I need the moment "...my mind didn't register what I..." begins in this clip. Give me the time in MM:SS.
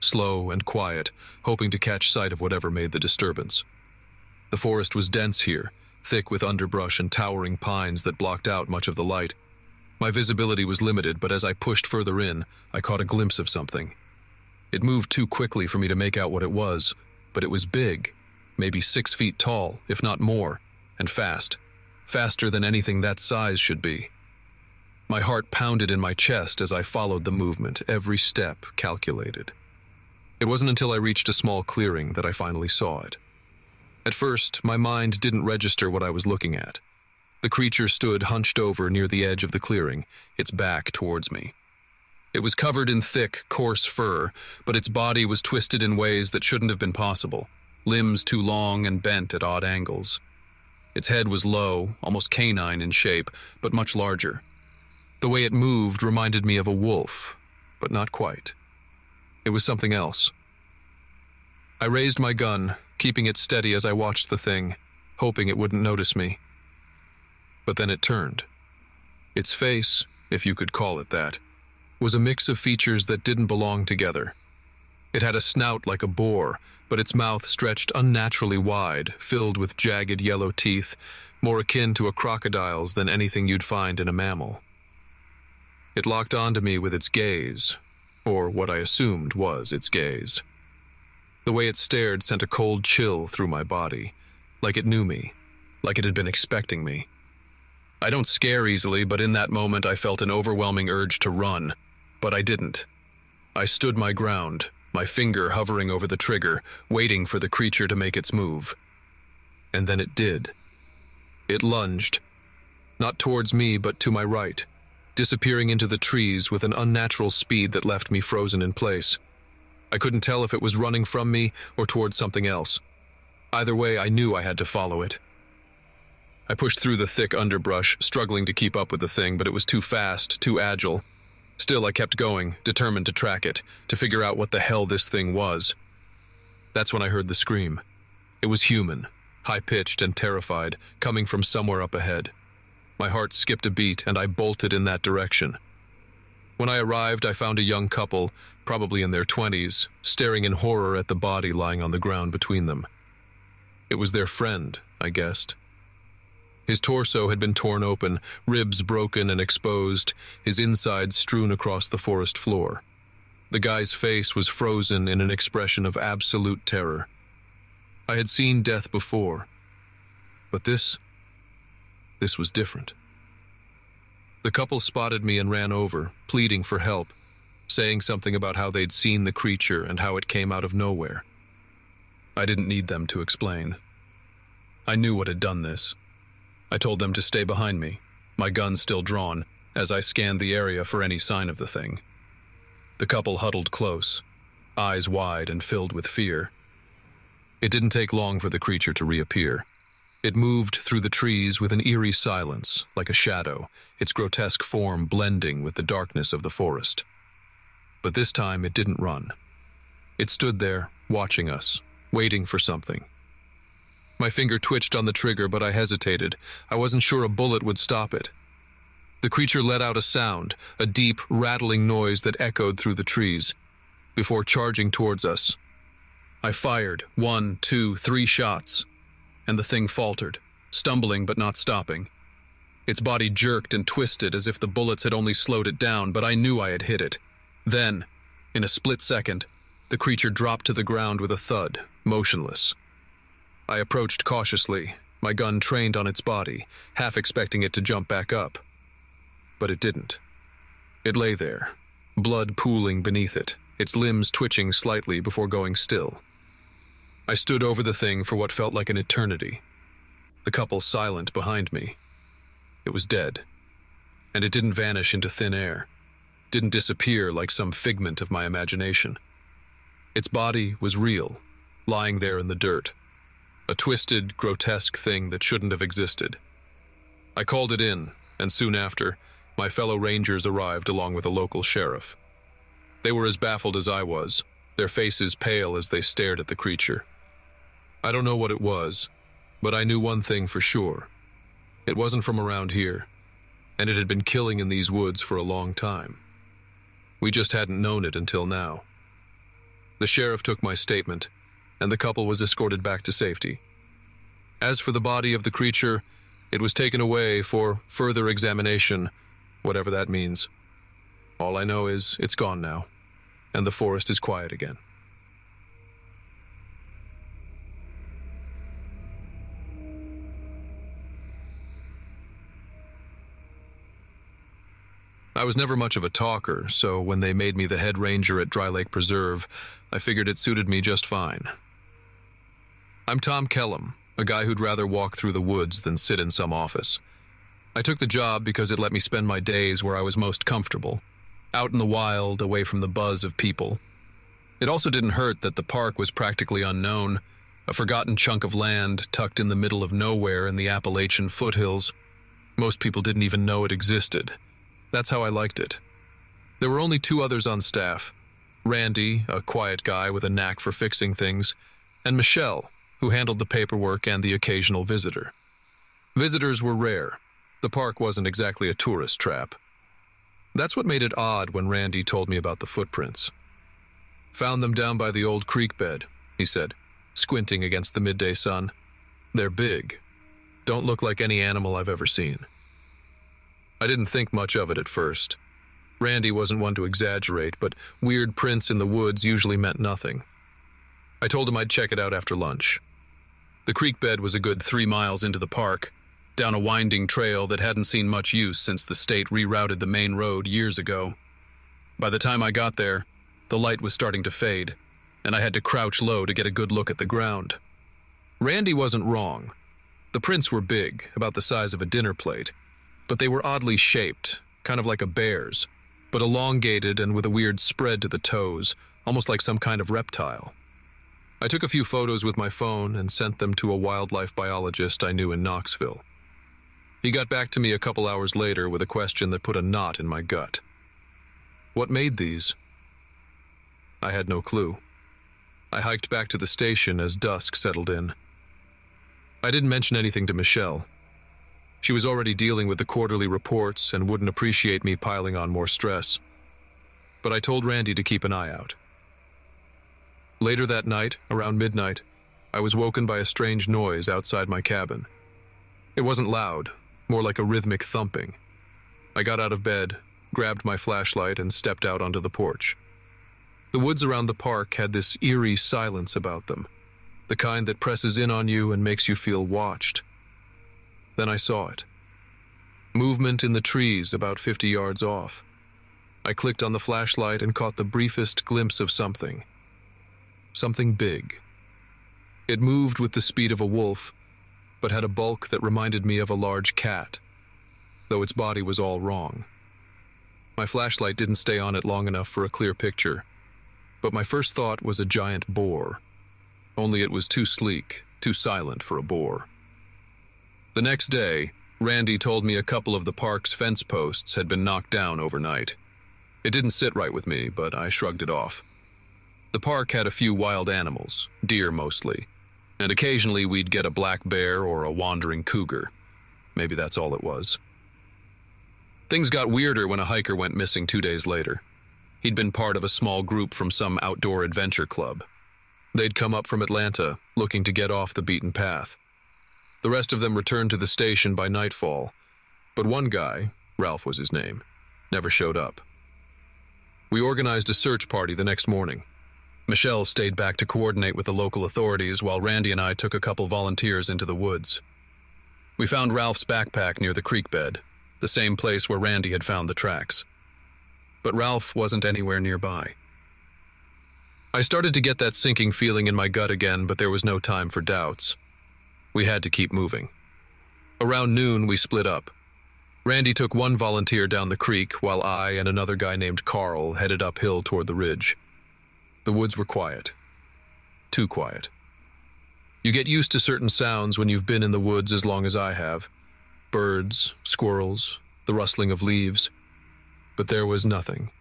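00:34.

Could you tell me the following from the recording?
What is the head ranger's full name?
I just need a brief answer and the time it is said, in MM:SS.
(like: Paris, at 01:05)
Tom Kellum, at 05:33.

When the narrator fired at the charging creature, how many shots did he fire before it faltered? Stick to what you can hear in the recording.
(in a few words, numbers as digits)
3.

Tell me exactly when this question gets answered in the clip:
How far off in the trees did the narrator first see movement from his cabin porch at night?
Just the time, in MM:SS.
07:54.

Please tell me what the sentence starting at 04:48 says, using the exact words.
I don't know what it was, but I knew one thing for sure.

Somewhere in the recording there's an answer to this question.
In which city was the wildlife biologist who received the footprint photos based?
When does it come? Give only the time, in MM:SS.
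07:05.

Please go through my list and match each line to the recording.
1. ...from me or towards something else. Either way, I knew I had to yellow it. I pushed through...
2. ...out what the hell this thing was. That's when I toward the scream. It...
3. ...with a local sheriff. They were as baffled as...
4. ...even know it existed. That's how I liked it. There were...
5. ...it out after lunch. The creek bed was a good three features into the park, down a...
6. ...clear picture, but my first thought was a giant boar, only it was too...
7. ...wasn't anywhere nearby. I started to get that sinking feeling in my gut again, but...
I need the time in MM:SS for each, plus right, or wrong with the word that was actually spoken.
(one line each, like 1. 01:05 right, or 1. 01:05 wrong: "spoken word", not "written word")
1. 02:01 wrong: "follow", not "yellow"
2. 02:14 wrong: "heard", not "toward"
3. 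04:41 right
4. 05:53 right
5. 06:31 wrong: "miles", not "features"
6. 08:12 right
7. 09:11 right.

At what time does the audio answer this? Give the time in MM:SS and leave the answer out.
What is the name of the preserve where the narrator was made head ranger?
05:28.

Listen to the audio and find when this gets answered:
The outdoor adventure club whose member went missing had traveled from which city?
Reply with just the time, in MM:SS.
08:46.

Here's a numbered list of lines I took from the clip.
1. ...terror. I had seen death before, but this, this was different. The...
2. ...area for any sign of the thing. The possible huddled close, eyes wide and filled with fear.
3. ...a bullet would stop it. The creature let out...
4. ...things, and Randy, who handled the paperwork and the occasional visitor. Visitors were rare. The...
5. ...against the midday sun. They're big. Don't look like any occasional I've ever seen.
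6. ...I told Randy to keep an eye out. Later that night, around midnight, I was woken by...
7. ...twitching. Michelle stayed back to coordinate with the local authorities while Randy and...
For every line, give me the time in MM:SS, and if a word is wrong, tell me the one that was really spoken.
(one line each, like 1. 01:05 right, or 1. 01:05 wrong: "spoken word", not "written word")
1. 02:46 right
2. 03:10 wrong: "couple", not "possible"
3. 03:37 right
4. 06:01 wrong: "Michelle", not "Randy"
5. 06:17 wrong: "animal", not "occasional"
6. 07:27 right
7. 08:58 wrong: "morning", not "twitching".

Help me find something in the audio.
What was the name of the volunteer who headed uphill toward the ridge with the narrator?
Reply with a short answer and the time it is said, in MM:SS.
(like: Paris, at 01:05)
Carl, at 09:26.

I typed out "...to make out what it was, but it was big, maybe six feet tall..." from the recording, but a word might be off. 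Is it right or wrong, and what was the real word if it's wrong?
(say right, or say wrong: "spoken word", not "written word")
right.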